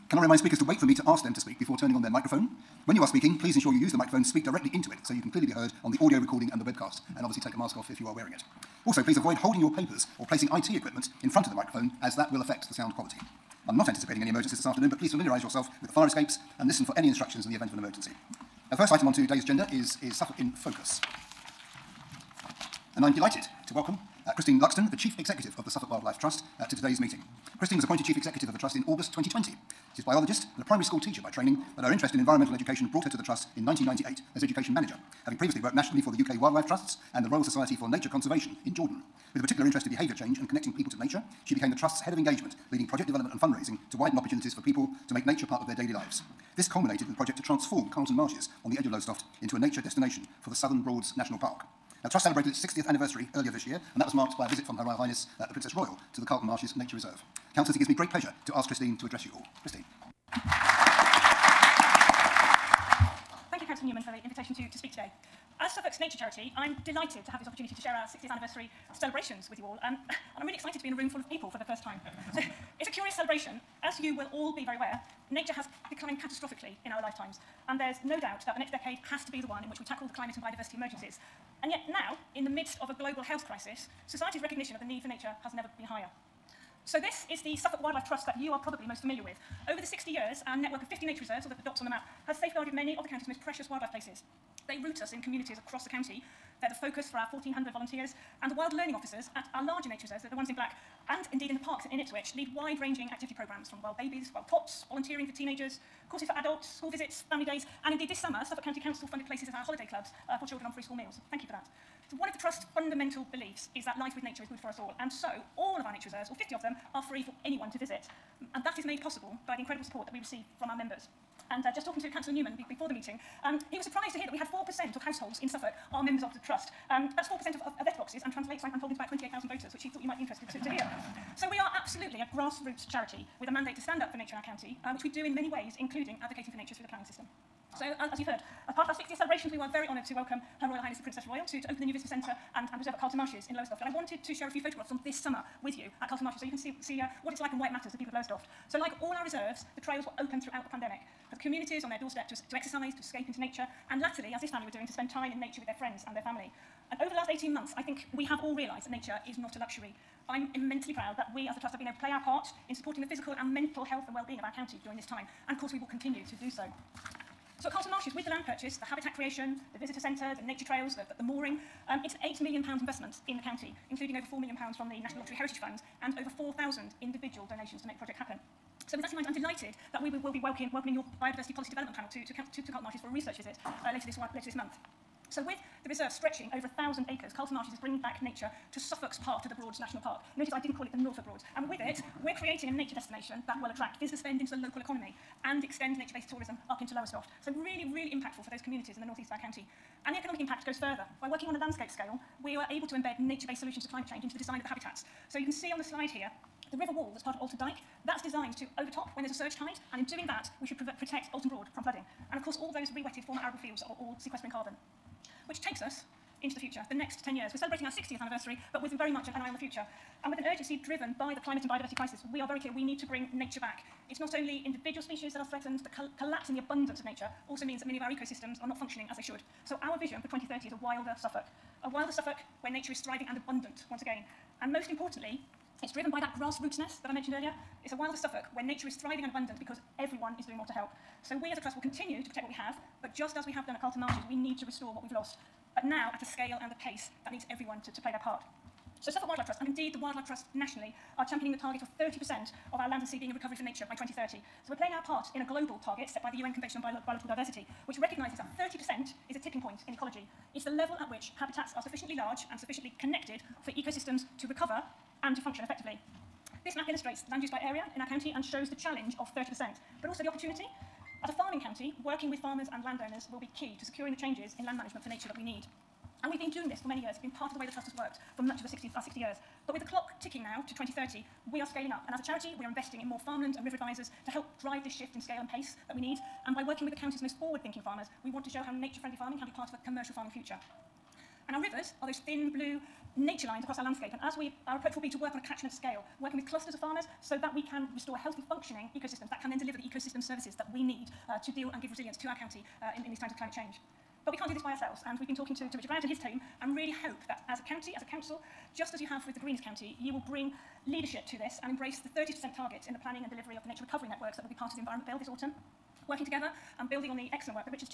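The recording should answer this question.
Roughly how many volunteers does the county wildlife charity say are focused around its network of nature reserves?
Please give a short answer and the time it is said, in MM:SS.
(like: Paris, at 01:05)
1,400, at 01:37.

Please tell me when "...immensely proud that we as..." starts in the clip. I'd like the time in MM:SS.
02:40.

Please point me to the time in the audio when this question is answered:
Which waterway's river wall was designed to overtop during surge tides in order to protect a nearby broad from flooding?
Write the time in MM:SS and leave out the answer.
03:27.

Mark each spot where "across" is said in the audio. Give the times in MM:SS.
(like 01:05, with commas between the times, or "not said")
01:35, 04:53.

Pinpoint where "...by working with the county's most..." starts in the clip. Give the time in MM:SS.
04:46.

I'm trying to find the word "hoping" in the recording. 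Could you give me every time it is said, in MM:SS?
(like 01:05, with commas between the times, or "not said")
not said.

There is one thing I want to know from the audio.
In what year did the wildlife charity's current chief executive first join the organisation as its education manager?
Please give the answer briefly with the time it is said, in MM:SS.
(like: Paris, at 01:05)
1998, at 00:33.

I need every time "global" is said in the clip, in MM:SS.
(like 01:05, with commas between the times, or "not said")
01:22, 04:15.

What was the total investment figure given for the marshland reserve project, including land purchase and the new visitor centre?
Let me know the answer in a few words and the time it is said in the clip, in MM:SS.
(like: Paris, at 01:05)
£8 million, at 02:52.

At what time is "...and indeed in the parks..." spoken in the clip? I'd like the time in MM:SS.
01:41.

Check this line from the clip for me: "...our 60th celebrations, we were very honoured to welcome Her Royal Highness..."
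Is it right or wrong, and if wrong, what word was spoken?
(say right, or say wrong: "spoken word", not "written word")
right.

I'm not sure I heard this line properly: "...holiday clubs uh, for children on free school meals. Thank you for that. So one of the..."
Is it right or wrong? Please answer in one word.
right.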